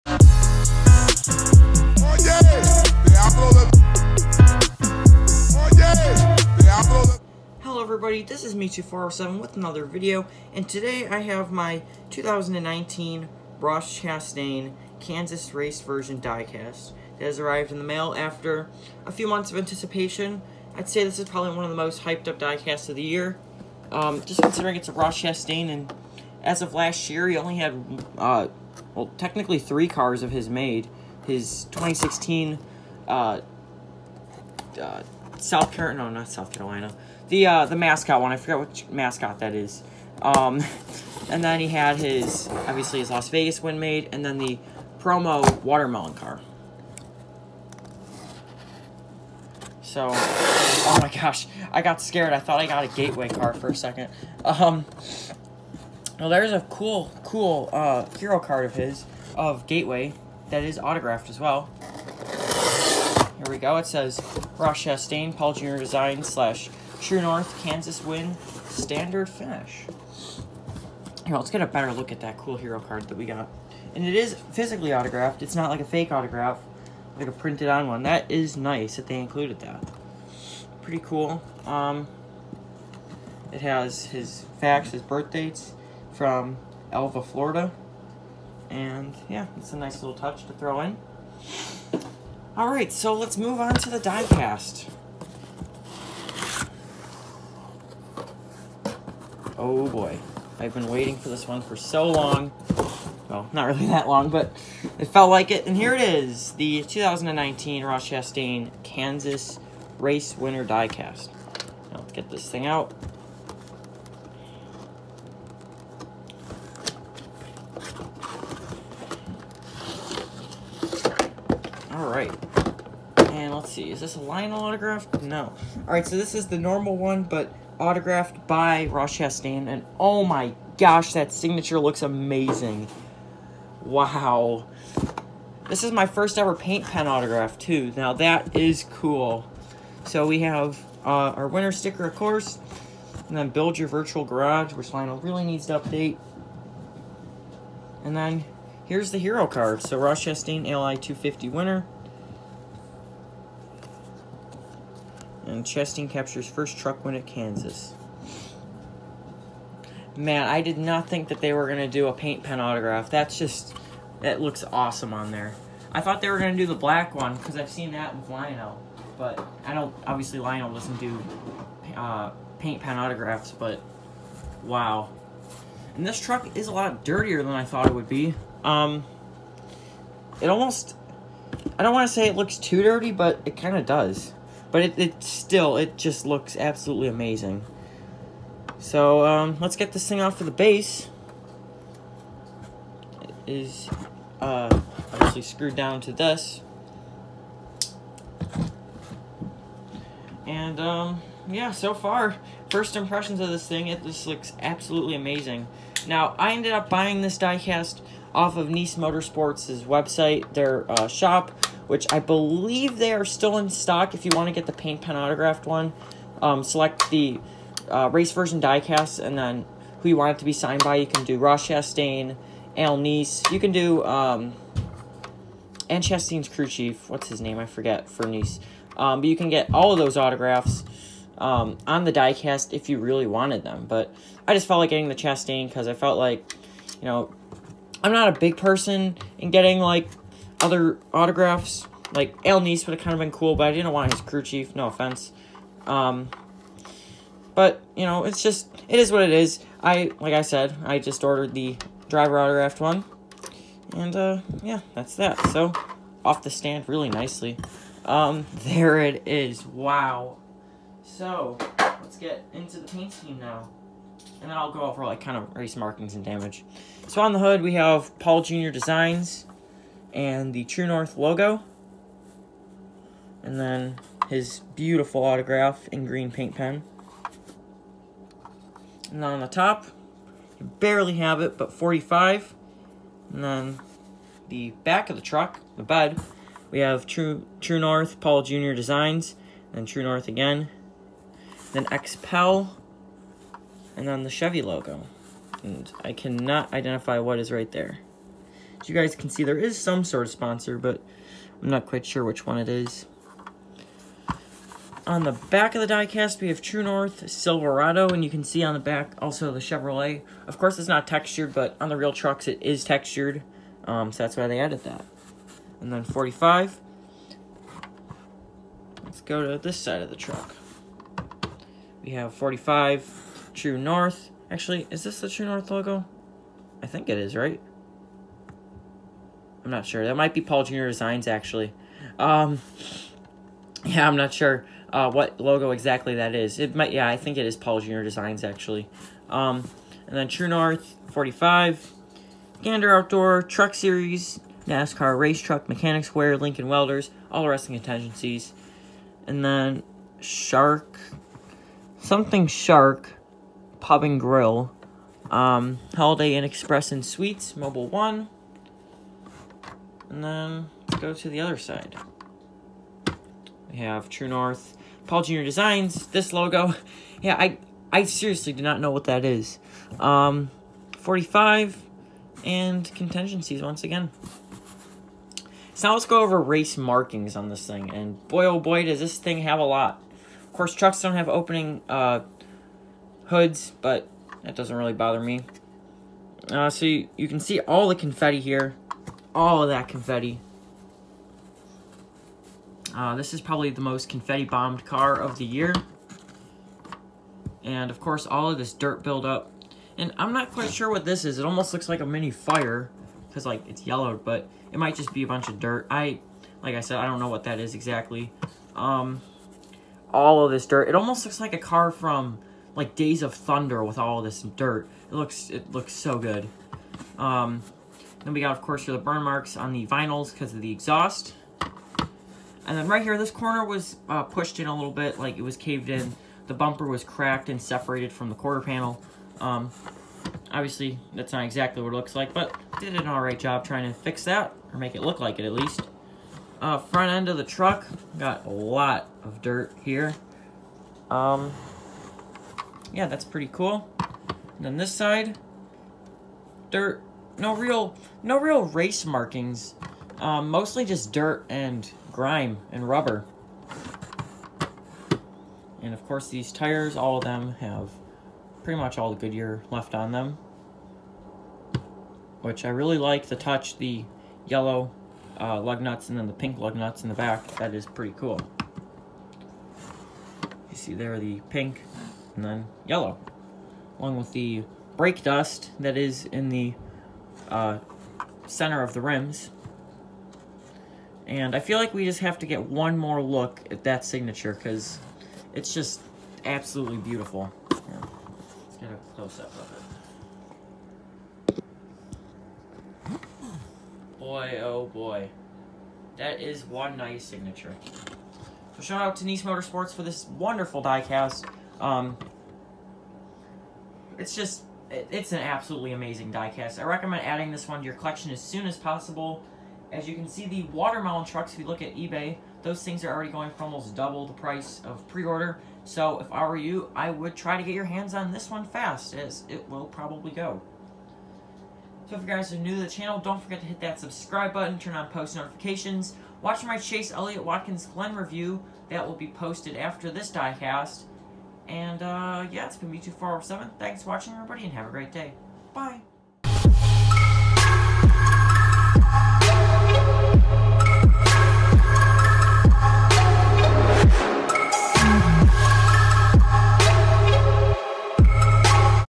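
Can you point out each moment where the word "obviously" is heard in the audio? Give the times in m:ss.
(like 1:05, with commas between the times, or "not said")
0:42, 2:50, 3:15, 7:10.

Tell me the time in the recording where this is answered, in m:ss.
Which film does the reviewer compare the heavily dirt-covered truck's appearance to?
6:52.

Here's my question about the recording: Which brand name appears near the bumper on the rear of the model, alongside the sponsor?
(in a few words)
Silverado.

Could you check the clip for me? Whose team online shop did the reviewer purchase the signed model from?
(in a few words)
Niece Motorsports.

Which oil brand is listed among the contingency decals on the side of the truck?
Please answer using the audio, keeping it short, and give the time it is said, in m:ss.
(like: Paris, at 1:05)
Mobil One, at 5:57.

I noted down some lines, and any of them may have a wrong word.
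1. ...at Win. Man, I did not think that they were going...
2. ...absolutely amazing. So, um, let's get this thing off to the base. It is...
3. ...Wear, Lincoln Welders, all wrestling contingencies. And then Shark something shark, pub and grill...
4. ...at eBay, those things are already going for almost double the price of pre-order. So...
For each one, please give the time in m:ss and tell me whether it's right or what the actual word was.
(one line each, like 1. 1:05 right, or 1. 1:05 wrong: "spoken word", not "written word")
1. 2:37 wrong: "Kansas", not "Win"
2. 3:06 right
3. 5:46 right
4. 8:31 right.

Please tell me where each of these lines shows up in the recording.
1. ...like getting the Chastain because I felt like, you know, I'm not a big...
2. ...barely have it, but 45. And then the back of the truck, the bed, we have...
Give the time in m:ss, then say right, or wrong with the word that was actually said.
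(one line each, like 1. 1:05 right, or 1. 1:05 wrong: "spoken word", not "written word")
1. 3:54 right
2. 4:40 right.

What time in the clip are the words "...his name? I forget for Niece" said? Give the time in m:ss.
3:47.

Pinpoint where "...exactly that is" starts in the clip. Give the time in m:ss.
5:35.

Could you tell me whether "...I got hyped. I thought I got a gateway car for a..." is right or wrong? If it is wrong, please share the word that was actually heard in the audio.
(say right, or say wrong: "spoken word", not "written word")
wrong: "scared", not "hyped".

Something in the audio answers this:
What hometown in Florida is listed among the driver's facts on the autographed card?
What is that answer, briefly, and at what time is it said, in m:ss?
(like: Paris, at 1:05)
Alva, Florida, at 1:26.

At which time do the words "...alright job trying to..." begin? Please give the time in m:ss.
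7:13.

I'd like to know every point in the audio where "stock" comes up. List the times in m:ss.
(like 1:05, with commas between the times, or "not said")
3:33.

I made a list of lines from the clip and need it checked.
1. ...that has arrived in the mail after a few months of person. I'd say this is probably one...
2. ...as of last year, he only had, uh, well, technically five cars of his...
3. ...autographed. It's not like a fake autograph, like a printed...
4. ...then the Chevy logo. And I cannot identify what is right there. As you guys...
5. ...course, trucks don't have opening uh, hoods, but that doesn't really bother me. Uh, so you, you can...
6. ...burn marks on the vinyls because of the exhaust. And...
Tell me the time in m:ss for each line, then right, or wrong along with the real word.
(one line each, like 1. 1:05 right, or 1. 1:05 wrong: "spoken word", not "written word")
1. 0:17 wrong: "anticipation", not "person"
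2. 0:26 wrong: "three", not "five"
3. 1:14 right
4. 4:54 right
5. 6:20 right
6. 6:59 right.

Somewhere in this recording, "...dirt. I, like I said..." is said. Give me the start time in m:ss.
6:45.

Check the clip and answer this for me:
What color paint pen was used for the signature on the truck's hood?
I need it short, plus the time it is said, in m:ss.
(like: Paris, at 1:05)
Green, at 4:36.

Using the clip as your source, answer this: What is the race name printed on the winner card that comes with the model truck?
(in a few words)
LI 250.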